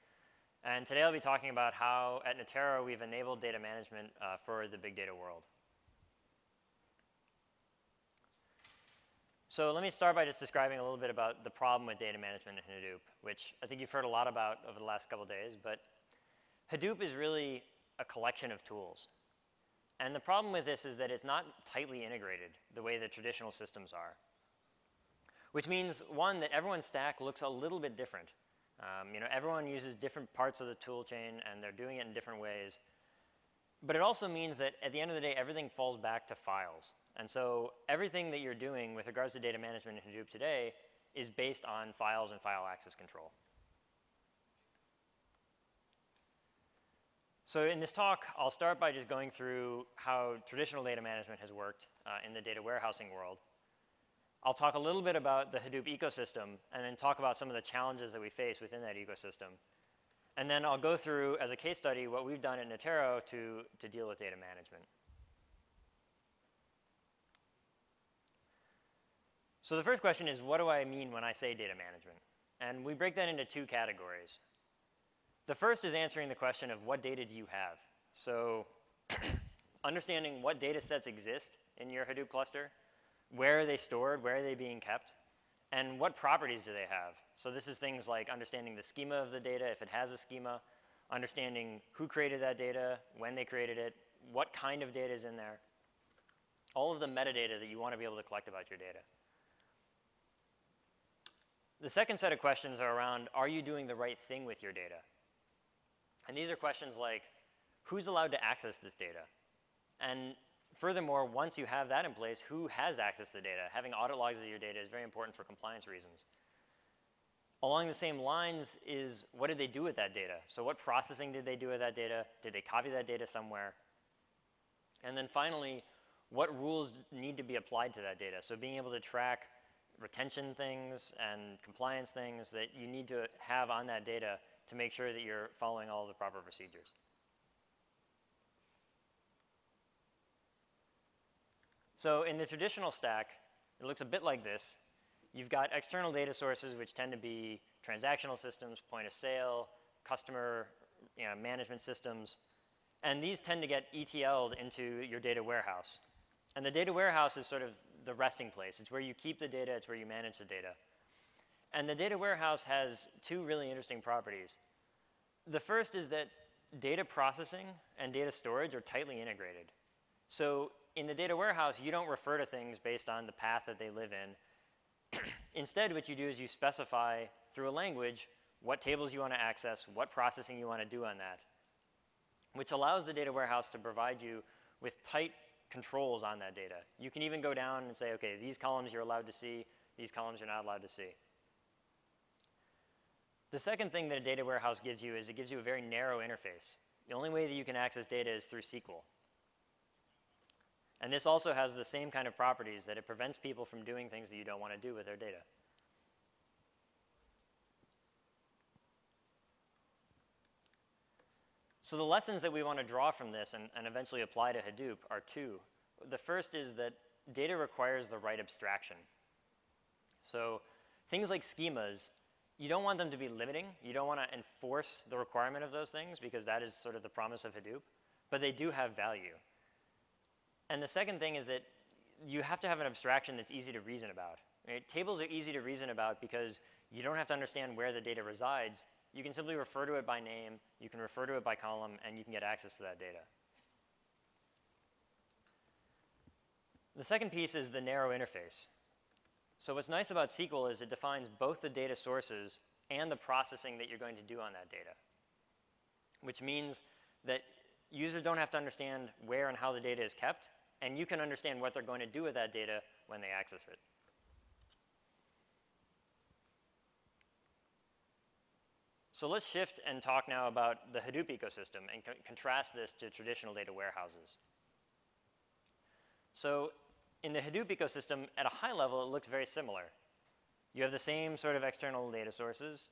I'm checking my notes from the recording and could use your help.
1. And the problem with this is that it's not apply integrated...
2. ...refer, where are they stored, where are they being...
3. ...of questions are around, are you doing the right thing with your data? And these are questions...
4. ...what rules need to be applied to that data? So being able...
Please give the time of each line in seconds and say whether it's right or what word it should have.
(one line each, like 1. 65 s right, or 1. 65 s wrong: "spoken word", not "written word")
1. 19 s wrong: "tightly", not "apply"
2. 82 s wrong: "cluster", not "refer"
3. 102 s right
4. 126 s right.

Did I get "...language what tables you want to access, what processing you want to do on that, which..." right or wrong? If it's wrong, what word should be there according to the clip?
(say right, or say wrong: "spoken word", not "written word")
right.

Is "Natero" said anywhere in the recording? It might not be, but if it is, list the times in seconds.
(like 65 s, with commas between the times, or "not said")
2 s, 62 s.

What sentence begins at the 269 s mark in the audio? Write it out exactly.
So let's shift and talk now about the Hadoop ecosystem and co contrast this to traditional data warehouses.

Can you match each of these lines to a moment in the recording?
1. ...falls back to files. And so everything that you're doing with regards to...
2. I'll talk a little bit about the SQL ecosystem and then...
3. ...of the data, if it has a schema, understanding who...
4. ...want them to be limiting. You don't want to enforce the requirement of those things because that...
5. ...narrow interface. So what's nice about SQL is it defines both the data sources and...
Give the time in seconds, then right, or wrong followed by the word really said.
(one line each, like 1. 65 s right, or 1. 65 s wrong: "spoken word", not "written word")
1. 35 s right
2. 54 s wrong: "Hadoop", not "SQL"
3. 89 s right
4. 222 s right
5. 247 s right.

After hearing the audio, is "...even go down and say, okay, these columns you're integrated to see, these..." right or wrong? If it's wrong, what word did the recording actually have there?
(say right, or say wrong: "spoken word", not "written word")
wrong: "allowed", not "integrated".